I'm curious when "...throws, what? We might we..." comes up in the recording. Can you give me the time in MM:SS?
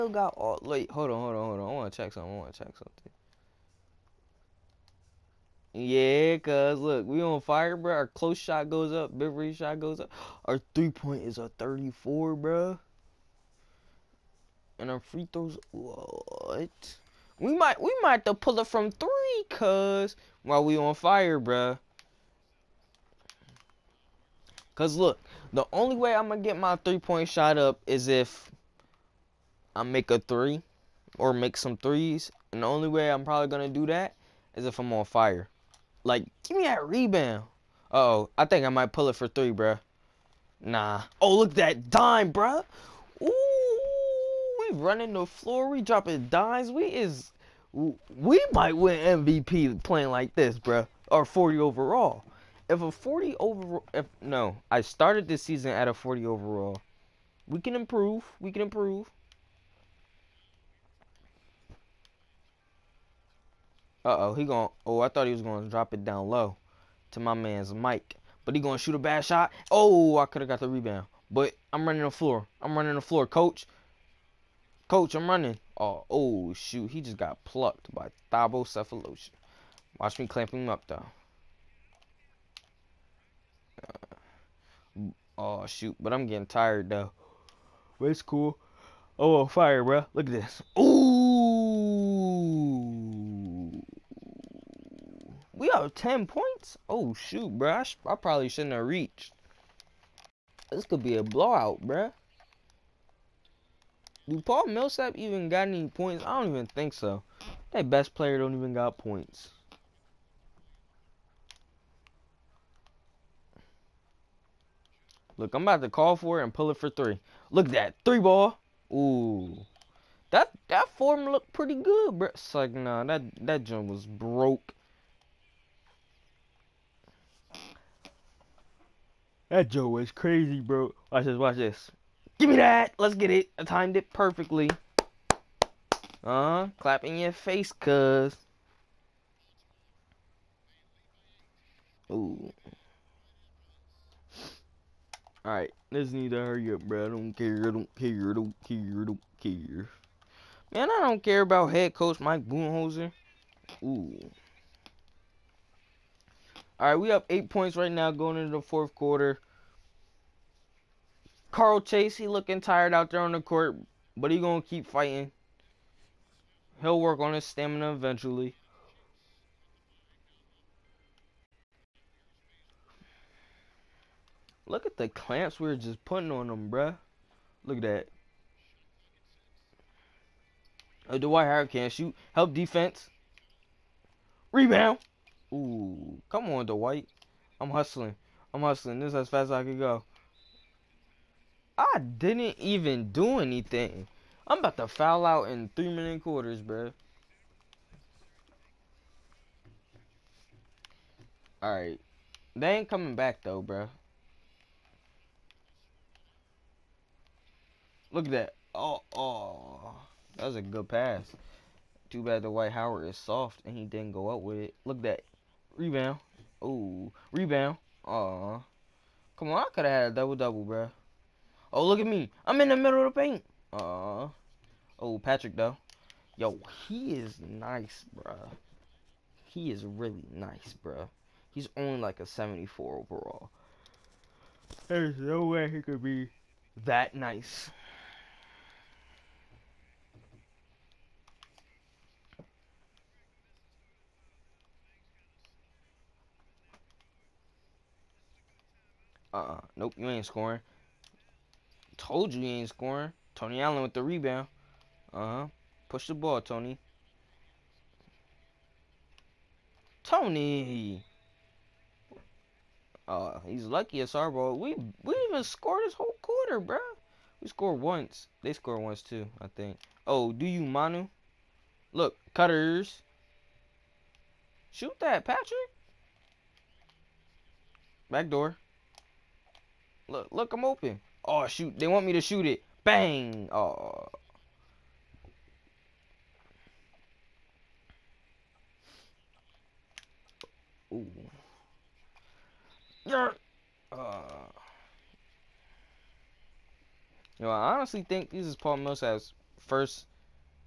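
00:15.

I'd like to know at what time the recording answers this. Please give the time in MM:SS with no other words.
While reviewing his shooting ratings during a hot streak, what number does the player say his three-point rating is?
00:11.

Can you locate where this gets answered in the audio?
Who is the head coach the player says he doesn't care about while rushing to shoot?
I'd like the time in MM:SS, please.
02:32.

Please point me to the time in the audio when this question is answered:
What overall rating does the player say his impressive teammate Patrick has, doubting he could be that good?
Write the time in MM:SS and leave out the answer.
03:52.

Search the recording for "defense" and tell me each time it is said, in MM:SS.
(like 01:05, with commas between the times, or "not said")
03:02.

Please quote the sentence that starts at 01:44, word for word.
Do Paul Millsap even got any points?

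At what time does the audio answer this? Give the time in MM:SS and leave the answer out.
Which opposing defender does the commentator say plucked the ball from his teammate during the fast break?
01:18.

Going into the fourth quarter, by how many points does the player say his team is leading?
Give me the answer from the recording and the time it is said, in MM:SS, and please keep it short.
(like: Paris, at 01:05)
8, at 02:37.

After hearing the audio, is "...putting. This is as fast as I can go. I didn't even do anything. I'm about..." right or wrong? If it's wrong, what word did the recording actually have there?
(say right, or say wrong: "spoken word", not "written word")
wrong: "hustling", not "putting".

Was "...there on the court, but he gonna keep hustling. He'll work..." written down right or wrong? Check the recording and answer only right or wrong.
wrong.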